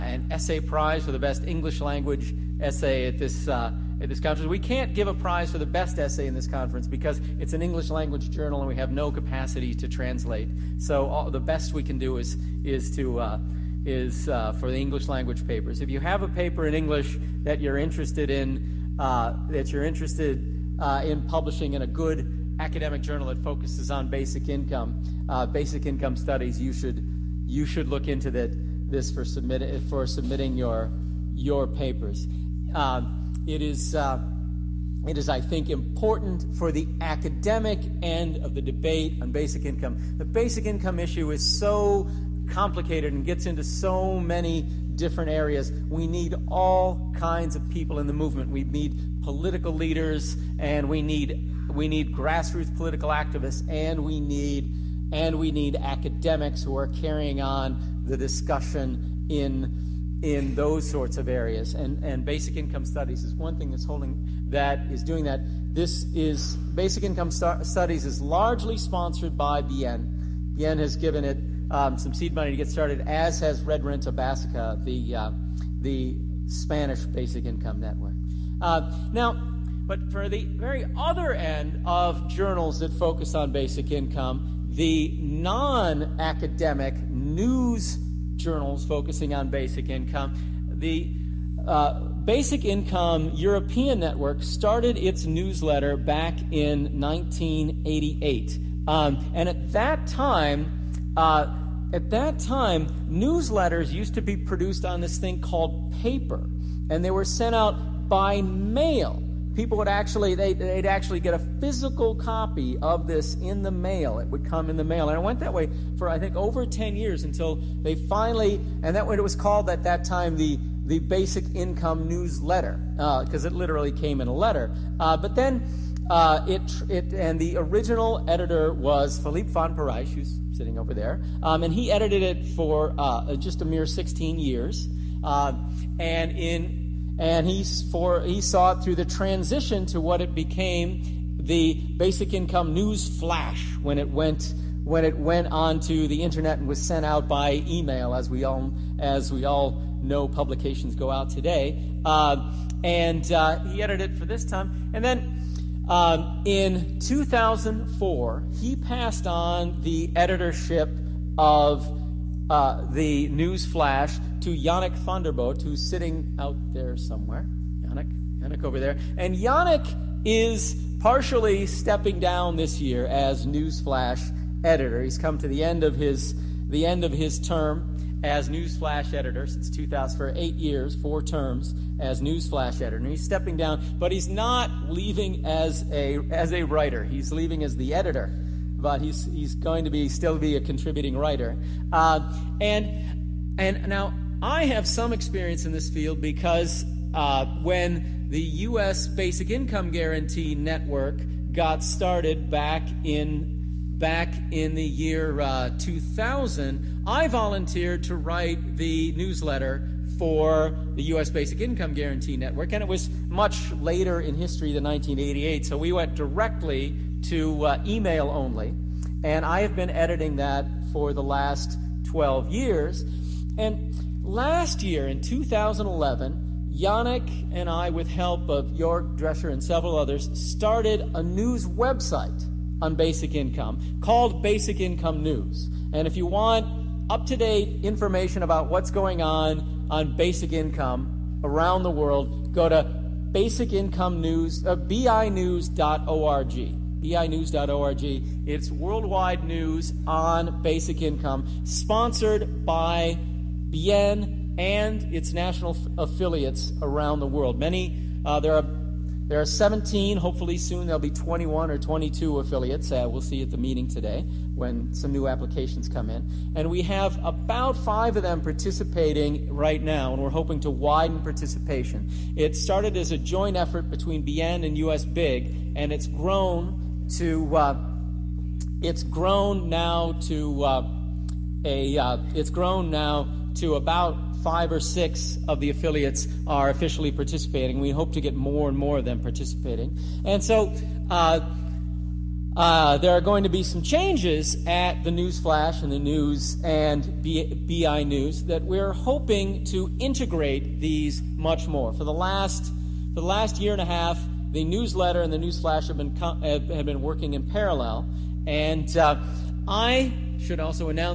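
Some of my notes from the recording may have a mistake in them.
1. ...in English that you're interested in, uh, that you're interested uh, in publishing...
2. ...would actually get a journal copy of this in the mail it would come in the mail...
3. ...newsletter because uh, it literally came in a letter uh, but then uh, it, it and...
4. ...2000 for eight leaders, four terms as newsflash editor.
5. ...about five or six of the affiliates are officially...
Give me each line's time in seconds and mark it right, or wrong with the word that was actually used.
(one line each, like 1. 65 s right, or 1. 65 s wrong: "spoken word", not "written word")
1. 16 s right
2. 110 s wrong: "physical", not "journal"
3. 122 s right
4. 179 s wrong: "years", not "leaders"
5. 283 s right.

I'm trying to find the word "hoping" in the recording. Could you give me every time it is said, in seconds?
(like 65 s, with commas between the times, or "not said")
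270 s, 298 s.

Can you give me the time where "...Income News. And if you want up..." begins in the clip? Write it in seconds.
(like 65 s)
234 s.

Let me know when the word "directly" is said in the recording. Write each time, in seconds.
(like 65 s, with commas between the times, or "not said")
216 s.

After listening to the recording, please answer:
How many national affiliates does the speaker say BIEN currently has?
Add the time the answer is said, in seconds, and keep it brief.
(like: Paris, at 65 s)
17, at 259 s.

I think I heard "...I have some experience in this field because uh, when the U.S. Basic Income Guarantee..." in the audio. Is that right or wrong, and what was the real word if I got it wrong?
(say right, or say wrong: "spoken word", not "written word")
right.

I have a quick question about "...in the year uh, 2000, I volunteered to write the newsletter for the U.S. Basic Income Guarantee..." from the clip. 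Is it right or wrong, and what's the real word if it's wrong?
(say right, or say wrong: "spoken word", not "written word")
right.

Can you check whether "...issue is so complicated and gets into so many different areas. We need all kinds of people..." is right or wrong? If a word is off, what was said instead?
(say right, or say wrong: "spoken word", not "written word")
right.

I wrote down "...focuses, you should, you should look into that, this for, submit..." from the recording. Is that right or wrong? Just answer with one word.
wrong.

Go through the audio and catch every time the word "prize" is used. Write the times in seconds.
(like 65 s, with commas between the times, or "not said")
0 s, 5 s.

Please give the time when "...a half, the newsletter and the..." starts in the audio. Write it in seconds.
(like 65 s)
303 s.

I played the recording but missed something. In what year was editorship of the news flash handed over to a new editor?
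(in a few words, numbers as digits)
2004.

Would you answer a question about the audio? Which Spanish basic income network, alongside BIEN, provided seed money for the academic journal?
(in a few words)
Red Renta Basica.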